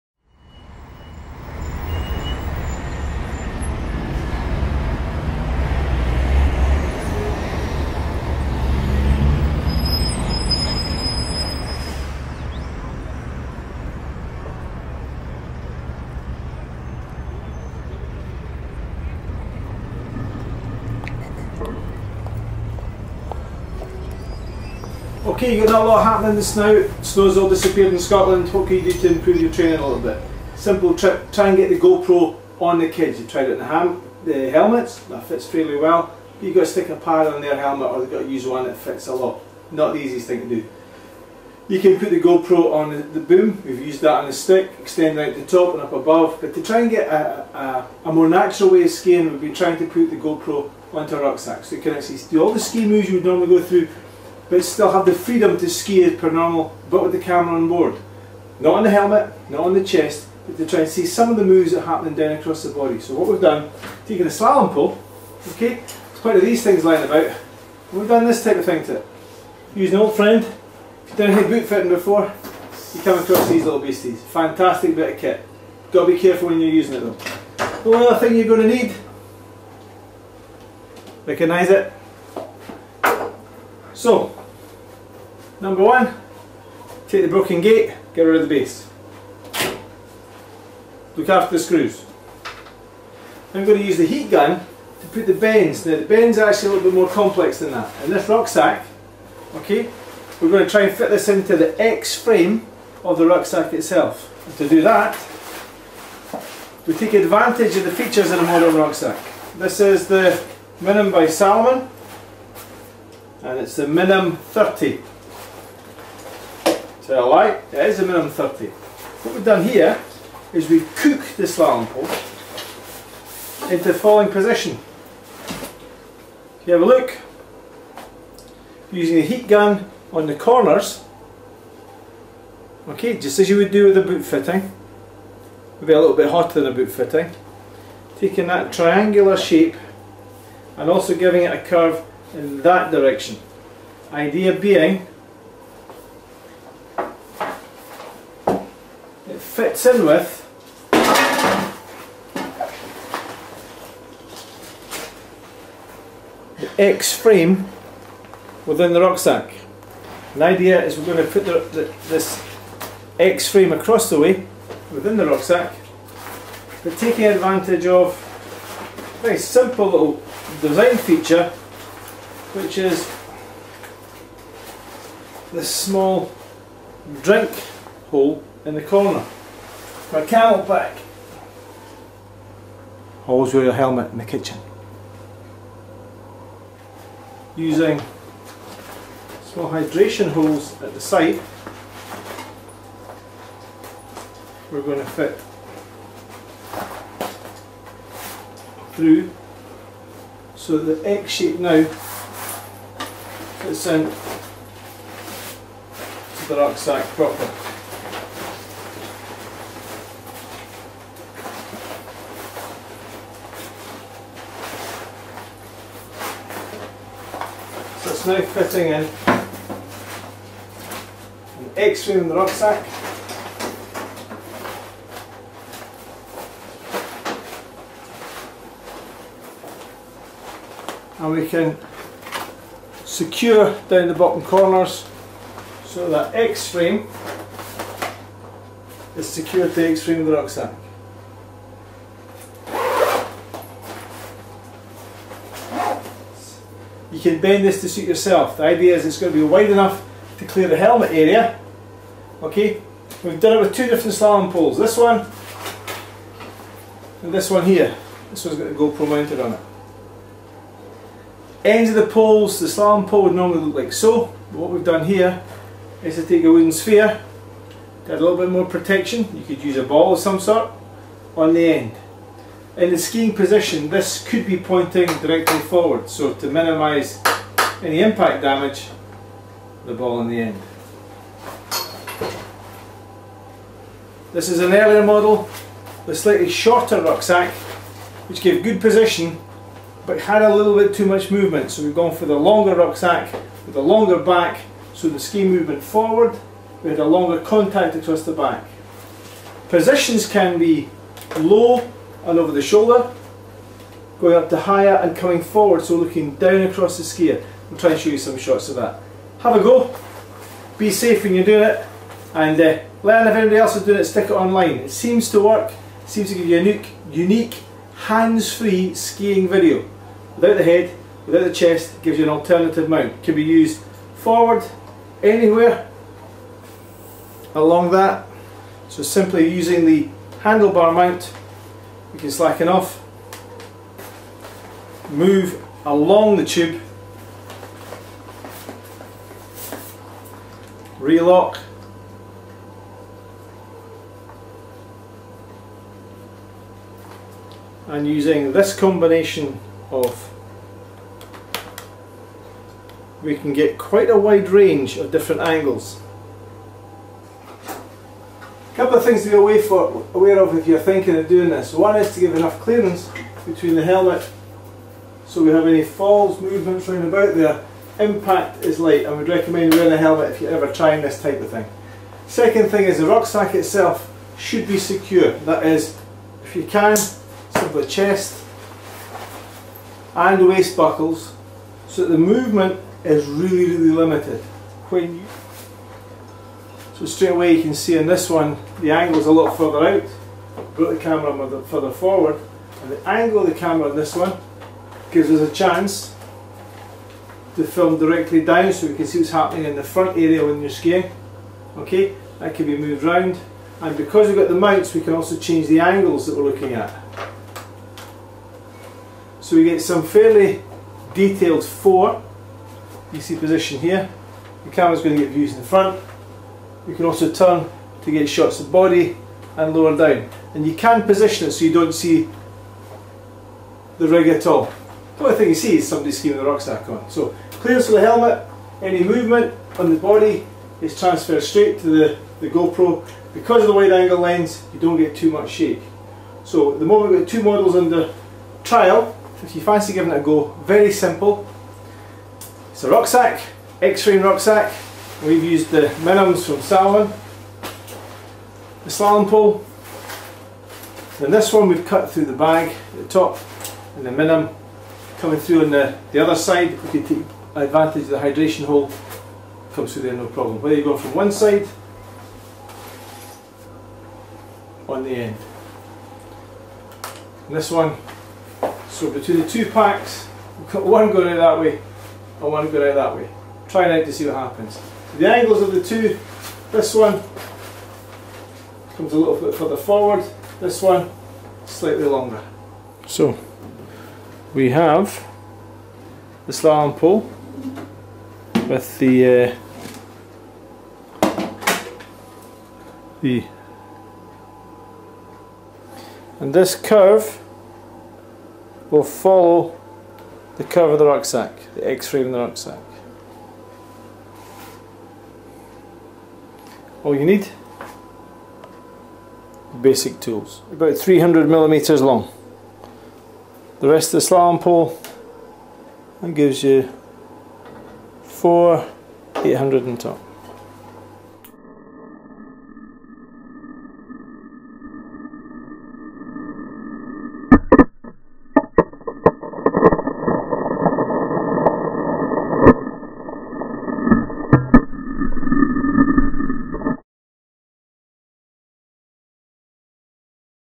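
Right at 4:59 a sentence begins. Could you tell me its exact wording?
Positions can be low and over the shoulder, going up to higher and coming forward, so looking down across the skier.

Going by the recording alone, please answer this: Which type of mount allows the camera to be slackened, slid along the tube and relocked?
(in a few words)
Handlebar mount.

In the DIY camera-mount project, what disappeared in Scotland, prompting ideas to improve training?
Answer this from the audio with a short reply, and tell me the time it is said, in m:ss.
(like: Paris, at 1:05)
Snow, at 0:27.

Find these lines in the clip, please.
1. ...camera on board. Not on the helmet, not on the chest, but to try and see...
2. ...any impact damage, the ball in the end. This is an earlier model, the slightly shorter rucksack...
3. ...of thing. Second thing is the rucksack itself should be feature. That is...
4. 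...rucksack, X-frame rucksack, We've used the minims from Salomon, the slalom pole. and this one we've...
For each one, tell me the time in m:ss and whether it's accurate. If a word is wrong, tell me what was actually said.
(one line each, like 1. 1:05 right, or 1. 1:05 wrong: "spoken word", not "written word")
1. 0:57 right
2. 4:37 right
3. 6:11 wrong: "secure", not "feature"
4. 7:22 right.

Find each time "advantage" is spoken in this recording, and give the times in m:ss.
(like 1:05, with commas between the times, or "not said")
1:47, 2:47, 7:37.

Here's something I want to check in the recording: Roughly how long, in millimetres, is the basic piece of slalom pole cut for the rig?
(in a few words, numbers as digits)
300.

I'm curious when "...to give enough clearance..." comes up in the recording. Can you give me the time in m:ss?
6:02.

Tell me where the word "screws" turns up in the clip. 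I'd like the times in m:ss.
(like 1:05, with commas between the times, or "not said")
1:31.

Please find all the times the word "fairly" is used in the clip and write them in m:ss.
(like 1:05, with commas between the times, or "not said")
0:35, 6:50.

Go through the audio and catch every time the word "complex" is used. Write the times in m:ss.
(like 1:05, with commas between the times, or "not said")
1:37.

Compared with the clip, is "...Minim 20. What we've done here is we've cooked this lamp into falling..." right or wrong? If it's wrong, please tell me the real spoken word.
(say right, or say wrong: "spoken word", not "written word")
wrong: "30", not "20".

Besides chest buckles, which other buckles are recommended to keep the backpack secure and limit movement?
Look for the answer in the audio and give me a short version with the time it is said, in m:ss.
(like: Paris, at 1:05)
Waist buckles, at 6:20.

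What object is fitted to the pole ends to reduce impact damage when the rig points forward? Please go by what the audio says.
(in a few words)
Wooden sphere.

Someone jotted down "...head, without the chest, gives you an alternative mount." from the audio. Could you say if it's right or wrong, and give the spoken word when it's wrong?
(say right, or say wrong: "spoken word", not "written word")
right.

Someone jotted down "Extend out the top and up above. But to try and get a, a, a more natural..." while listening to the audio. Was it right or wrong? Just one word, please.
right.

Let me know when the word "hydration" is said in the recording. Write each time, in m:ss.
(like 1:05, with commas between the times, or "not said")
3:09, 7:38.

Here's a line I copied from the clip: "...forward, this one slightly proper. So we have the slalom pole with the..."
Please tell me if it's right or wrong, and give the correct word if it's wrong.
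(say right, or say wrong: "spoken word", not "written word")
wrong: "longer", not "proper".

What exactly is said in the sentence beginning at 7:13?
Because of the wide angle lens, you don't get too much shake.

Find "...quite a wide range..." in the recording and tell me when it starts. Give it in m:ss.
5:53.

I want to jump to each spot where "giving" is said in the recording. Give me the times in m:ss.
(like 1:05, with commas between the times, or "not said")
2:21, 7:19.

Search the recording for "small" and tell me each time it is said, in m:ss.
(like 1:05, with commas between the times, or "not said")
2:55, 3:09.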